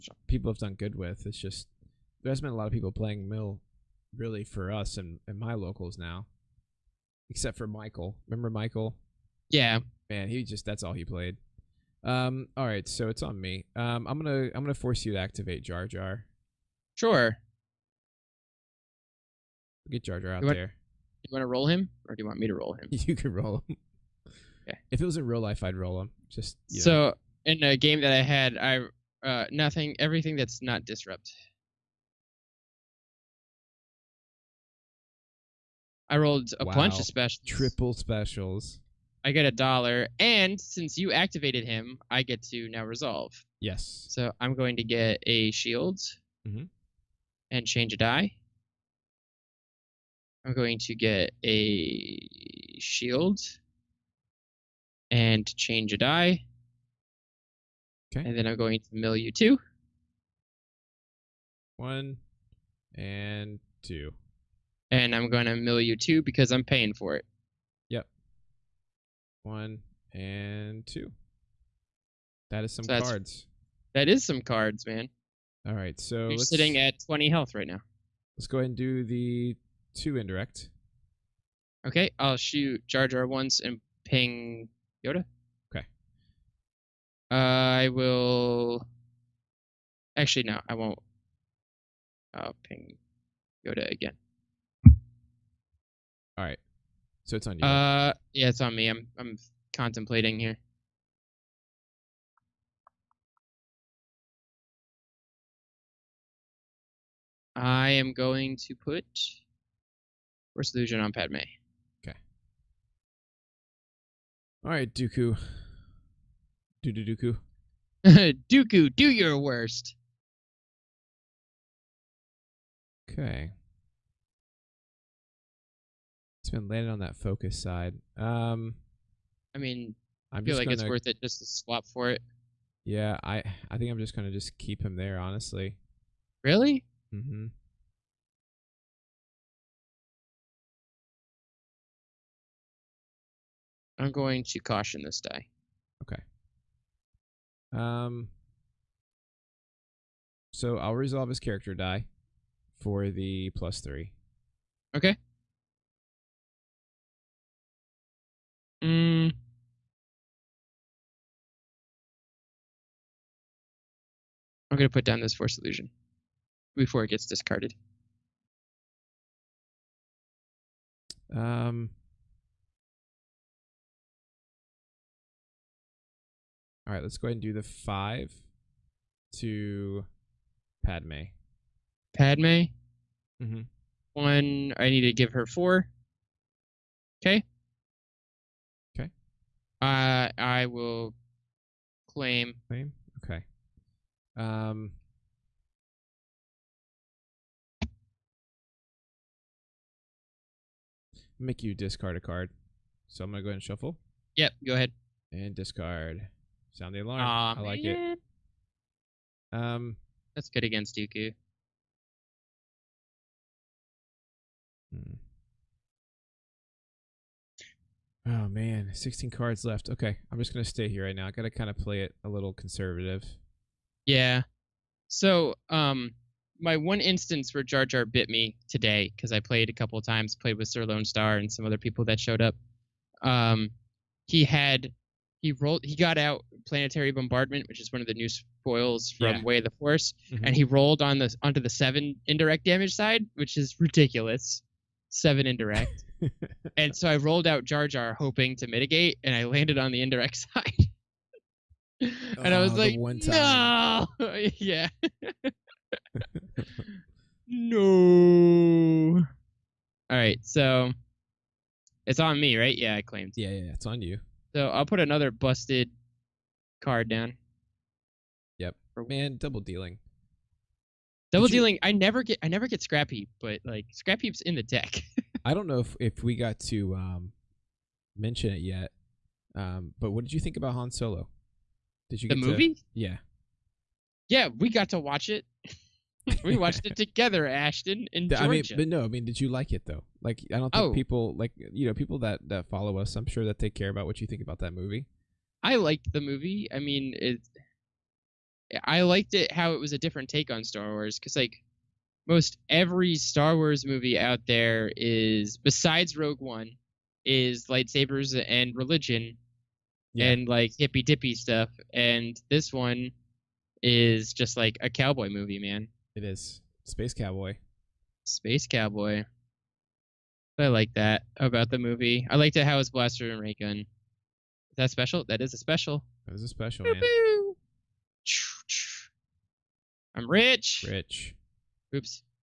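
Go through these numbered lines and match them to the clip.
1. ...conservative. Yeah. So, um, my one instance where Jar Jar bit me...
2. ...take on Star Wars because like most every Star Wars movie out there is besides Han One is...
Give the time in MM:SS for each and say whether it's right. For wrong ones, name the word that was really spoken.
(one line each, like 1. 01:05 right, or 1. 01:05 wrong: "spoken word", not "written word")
1. 03:42 right
2. 05:00 wrong: "Rogue", not "Han".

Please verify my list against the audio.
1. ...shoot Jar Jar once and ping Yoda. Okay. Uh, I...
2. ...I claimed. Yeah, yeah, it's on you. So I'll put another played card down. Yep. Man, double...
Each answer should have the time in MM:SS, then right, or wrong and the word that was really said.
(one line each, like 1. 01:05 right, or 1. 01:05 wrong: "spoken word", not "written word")
1. 01:22 right
2. 04:22 wrong: "busted", not "played".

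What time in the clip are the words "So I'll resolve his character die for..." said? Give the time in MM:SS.
02:30.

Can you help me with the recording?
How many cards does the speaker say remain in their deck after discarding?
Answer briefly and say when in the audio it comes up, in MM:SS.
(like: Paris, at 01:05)
16, at 03:38.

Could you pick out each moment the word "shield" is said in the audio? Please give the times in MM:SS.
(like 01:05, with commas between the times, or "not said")
00:45, 00:52.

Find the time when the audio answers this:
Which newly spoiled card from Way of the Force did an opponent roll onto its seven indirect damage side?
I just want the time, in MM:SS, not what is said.
03:56.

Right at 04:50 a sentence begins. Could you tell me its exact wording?
people like you know people that that follow us.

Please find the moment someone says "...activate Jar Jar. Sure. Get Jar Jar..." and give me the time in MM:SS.
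00:15.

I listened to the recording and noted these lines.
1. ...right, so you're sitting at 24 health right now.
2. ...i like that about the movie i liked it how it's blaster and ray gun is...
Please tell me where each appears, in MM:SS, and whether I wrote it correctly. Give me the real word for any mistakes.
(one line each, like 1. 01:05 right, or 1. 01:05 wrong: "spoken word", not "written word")
1. 01:15 wrong: "20", not "24"
2. 05:20 right.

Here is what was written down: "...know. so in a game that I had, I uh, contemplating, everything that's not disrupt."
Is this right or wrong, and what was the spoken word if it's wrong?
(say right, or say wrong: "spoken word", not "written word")
wrong: "nothing", not "contemplating".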